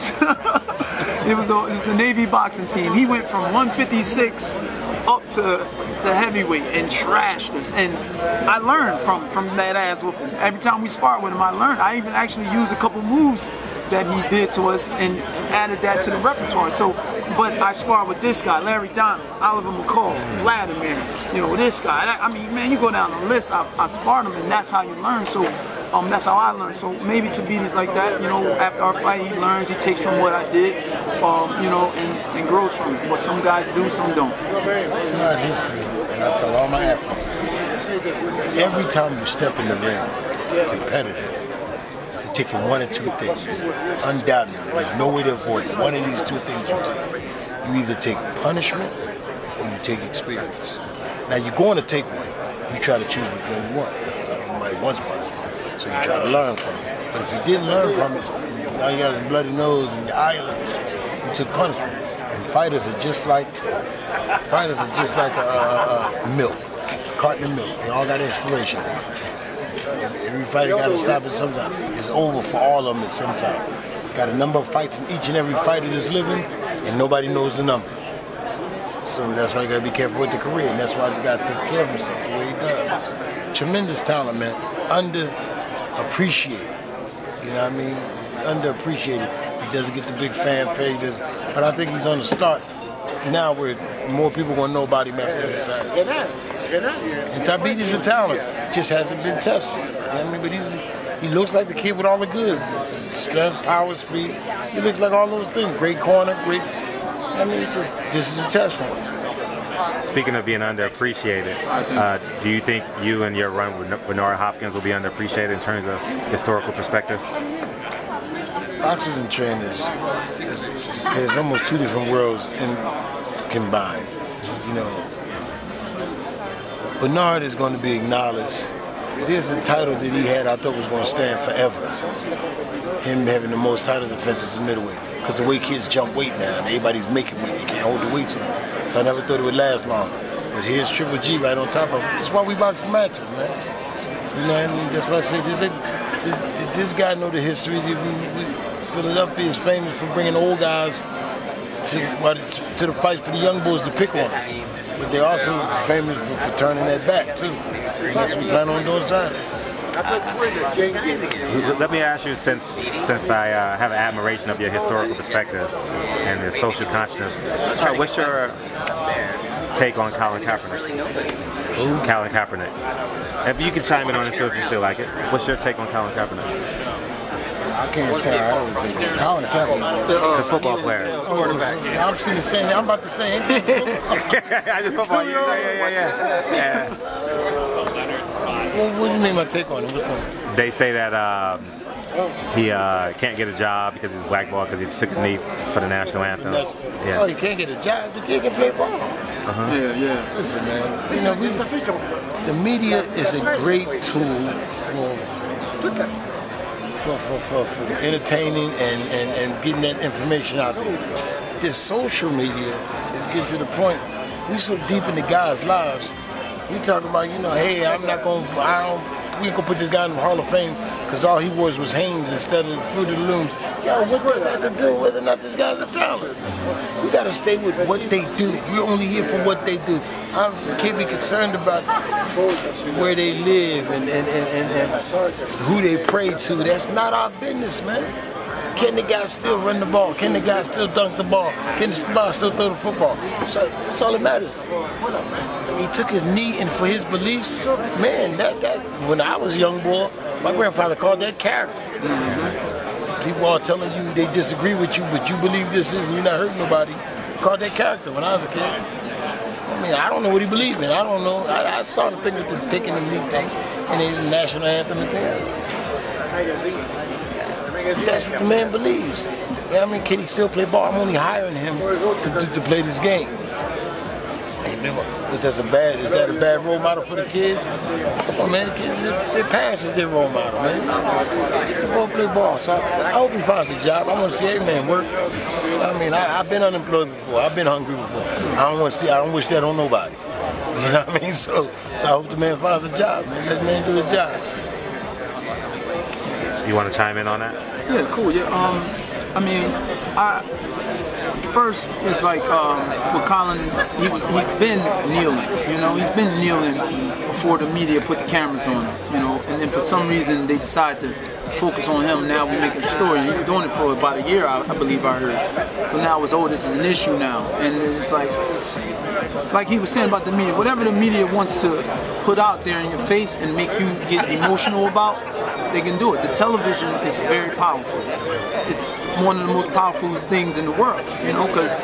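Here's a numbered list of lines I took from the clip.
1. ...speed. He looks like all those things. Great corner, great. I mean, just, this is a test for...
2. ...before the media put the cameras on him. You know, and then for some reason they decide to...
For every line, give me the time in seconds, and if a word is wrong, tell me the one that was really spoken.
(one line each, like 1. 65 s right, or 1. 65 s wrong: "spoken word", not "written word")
1. 103 s right
2. 307 s right.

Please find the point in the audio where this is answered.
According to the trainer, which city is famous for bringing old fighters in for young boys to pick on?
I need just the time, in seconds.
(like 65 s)
148 s.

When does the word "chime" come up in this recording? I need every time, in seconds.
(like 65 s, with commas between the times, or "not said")
173 s, 296 s.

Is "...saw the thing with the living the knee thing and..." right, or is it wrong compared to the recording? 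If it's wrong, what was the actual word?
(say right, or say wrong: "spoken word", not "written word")
wrong: "taking", not "living".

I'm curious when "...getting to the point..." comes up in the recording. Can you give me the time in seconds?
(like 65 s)
213 s.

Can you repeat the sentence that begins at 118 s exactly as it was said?
Boxers and trainers, there's almost two different worlds in, combined.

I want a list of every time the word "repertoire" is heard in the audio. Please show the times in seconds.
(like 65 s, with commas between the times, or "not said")
16 s.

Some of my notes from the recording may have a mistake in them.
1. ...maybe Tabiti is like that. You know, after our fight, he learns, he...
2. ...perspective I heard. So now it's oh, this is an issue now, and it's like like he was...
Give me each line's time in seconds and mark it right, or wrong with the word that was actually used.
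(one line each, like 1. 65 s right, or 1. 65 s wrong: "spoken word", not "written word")
1. 27 s right
2. 314 s wrong: "believe", not "perspective".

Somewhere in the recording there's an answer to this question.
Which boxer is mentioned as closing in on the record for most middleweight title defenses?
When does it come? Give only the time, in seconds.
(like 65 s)
140 s.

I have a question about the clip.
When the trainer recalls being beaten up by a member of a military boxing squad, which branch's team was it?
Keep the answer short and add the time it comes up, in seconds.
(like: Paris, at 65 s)
Navy, at 1 s.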